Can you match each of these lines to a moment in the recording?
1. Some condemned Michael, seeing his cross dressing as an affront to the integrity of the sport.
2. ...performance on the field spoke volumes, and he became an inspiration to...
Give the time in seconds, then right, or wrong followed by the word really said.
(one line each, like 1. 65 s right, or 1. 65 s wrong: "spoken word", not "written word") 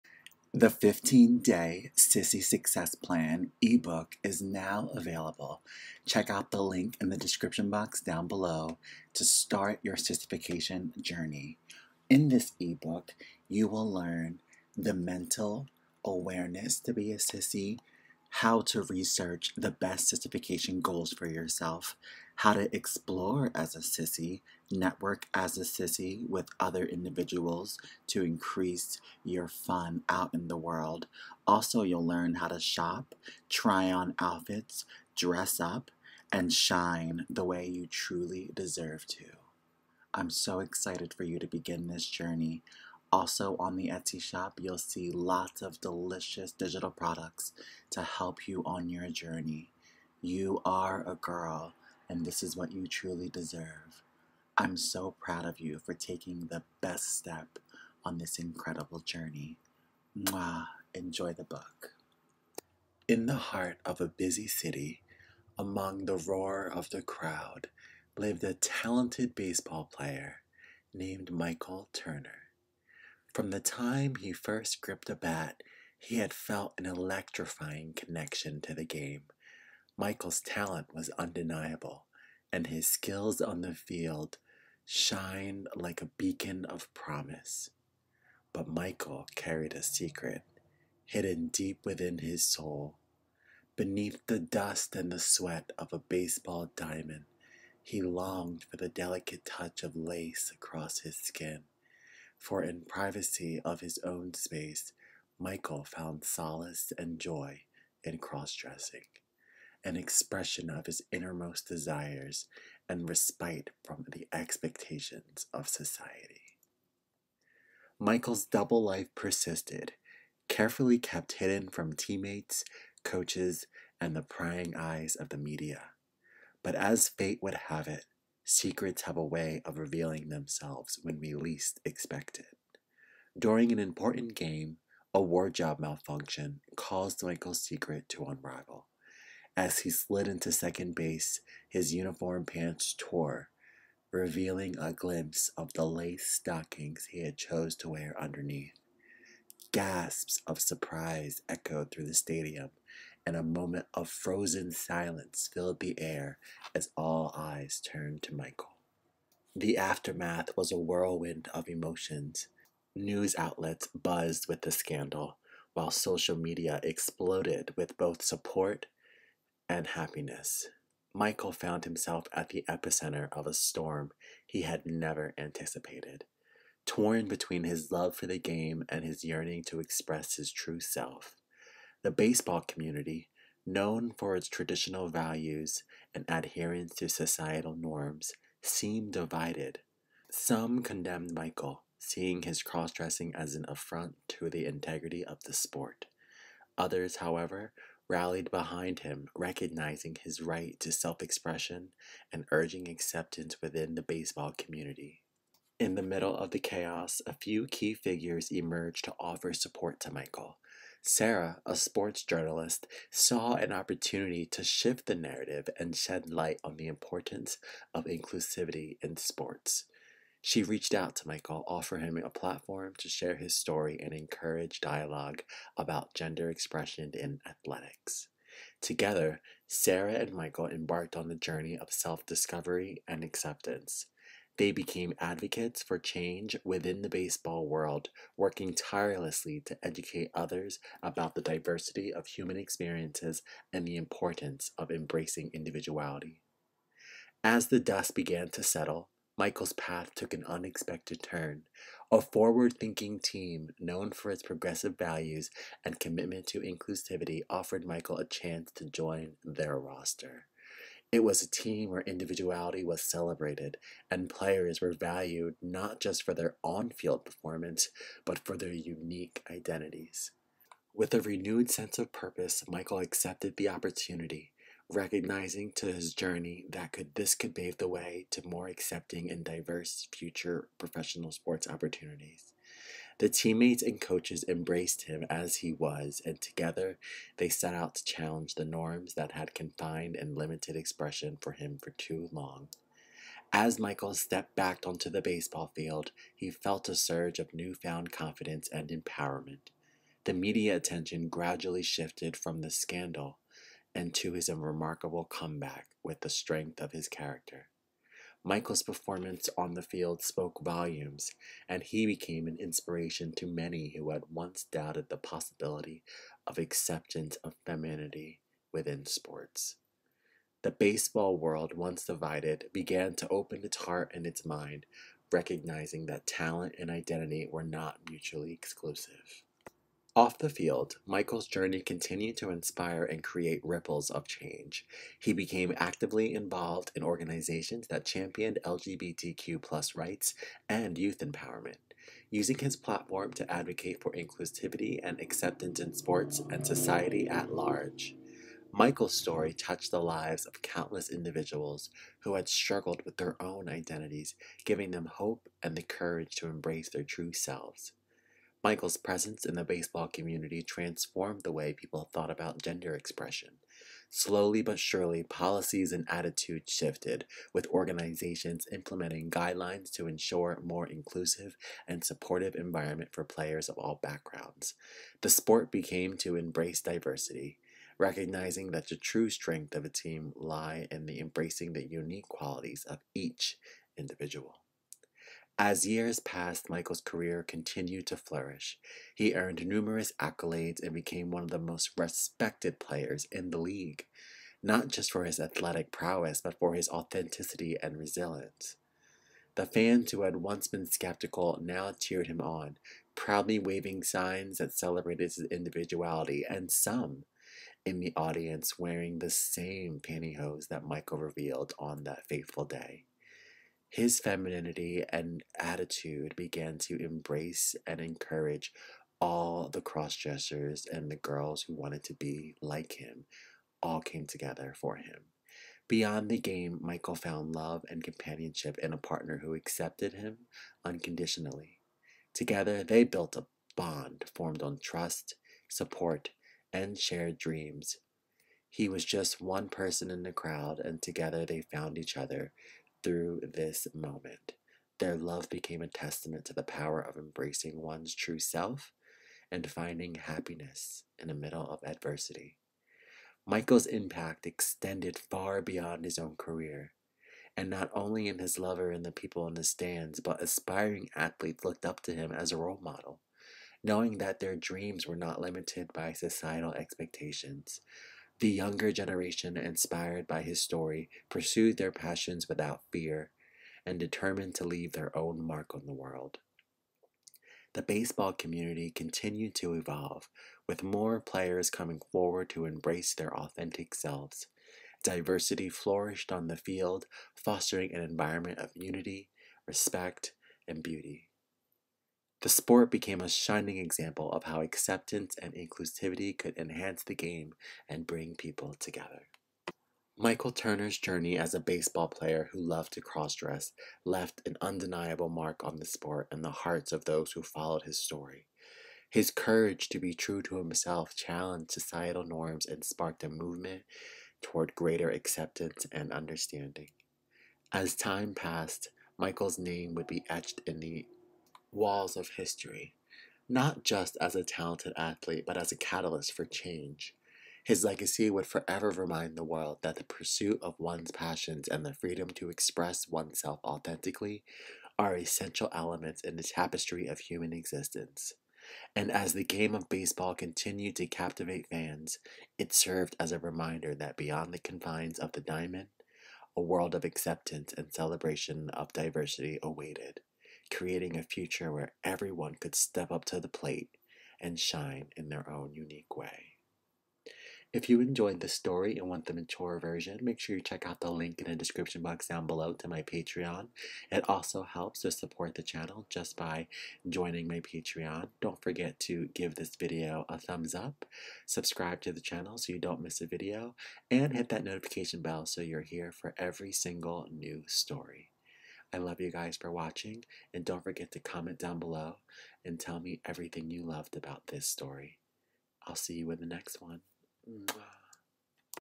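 1. 190 s right
2. 308 s right.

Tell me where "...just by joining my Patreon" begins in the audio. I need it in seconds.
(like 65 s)
566 s.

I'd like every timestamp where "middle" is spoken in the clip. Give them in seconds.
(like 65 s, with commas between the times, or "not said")
206 s, 451 s.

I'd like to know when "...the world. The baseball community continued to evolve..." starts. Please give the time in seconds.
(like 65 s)
475 s.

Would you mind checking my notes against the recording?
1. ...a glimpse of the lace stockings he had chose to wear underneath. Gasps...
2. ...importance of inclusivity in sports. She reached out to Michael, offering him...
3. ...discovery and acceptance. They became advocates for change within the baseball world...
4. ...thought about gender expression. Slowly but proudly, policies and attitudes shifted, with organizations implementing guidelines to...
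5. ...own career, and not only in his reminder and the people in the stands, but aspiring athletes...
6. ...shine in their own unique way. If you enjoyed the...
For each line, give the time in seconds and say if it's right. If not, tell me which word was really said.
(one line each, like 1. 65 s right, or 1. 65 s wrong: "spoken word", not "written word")
1. 144 s right
2. 216 s right
3. 232 s right
4. 362 s wrong: "surely", not "proudly"
5. 456 s wrong: "lover", not "reminder"
6. 554 s right.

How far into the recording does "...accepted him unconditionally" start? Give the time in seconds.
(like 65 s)
429 s.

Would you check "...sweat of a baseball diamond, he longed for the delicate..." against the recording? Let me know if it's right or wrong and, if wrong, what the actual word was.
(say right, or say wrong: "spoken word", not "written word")
right.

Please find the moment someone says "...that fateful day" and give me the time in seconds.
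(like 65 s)
412 s.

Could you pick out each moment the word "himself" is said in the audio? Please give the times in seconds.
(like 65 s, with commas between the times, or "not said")
171 s, 510 s.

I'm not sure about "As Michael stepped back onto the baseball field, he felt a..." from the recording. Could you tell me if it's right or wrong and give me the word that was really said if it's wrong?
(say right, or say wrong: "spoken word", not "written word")
right.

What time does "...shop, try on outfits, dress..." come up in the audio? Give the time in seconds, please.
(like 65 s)
32 s.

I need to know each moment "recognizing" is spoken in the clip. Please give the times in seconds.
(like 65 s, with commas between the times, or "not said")
199 s, 274 s, 325 s, 377 s.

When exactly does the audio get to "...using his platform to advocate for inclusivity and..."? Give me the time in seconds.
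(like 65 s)
342 s.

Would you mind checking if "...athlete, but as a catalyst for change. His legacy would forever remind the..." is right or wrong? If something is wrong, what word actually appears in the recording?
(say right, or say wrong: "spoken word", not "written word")
right.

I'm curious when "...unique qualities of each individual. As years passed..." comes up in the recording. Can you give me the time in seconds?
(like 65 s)
381 s.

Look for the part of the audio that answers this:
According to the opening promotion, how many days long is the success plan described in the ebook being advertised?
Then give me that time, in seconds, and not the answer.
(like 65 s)
0 s.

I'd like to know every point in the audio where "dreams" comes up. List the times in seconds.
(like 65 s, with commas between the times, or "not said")
437 s, 464 s.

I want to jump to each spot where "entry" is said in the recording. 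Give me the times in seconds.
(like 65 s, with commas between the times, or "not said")
not said.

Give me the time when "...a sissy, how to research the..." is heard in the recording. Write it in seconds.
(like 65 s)
17 s.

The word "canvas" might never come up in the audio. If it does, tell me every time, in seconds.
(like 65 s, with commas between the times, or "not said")
not said.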